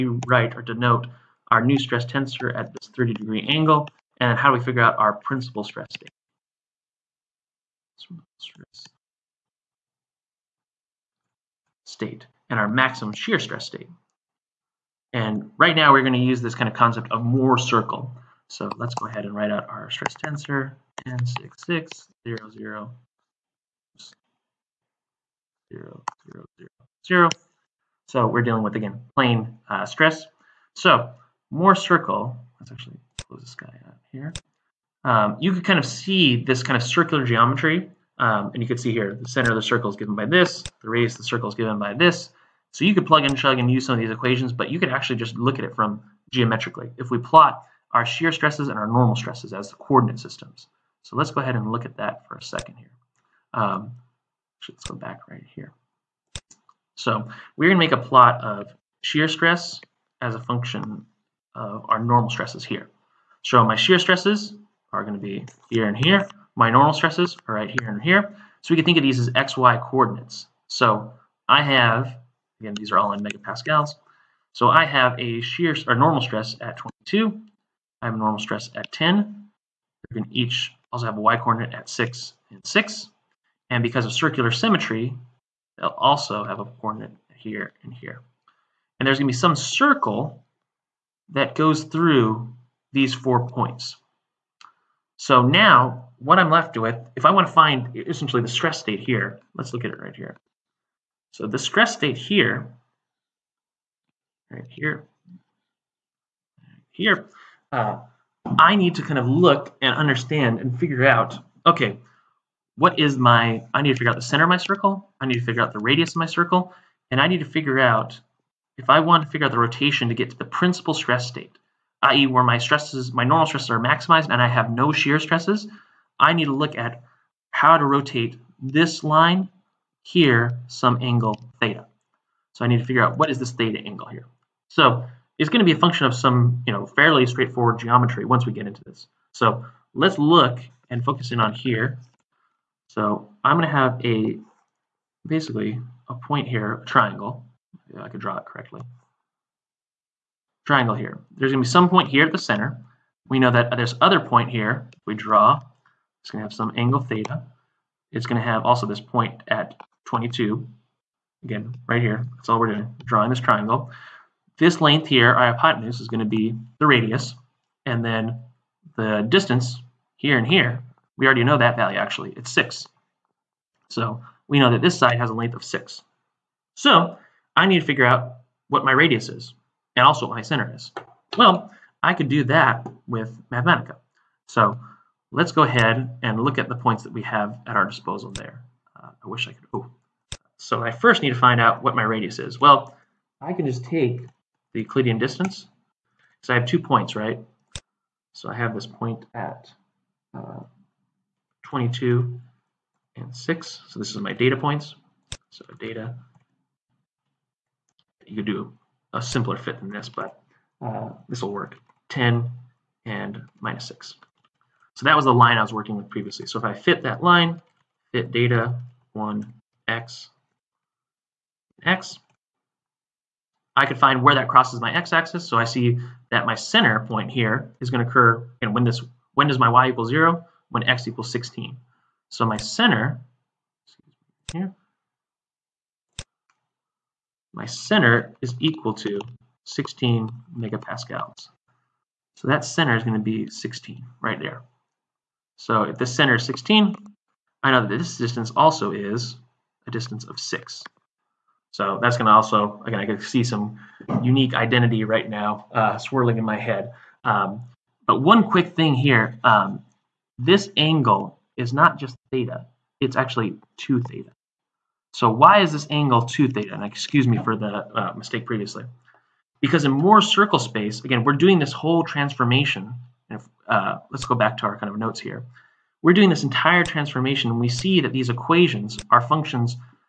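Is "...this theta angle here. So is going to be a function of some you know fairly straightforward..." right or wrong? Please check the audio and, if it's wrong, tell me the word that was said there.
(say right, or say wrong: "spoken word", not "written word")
right.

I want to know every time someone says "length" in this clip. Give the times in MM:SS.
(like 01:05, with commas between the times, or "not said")
02:44, 02:55.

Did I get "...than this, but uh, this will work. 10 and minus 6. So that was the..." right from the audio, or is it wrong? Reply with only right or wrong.
right.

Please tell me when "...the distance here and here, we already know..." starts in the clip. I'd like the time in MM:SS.
02:48.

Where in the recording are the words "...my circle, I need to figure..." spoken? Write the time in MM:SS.
01:54.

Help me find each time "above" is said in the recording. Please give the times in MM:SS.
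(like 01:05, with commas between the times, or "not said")
not said.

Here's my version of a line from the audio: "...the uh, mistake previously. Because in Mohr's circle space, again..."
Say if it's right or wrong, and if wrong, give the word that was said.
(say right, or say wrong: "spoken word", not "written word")
right.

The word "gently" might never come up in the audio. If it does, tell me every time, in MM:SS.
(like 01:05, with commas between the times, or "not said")
not said.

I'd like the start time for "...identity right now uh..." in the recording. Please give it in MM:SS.
04:14.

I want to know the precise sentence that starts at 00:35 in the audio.
Um, you could kind of see this kind of circular geometry.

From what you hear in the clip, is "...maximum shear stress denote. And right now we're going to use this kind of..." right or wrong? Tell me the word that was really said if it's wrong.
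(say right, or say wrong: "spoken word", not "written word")
wrong: "state", not "denote".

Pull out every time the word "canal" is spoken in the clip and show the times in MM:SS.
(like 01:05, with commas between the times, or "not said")
not said.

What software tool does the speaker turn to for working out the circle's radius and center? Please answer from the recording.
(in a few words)
Mathematica.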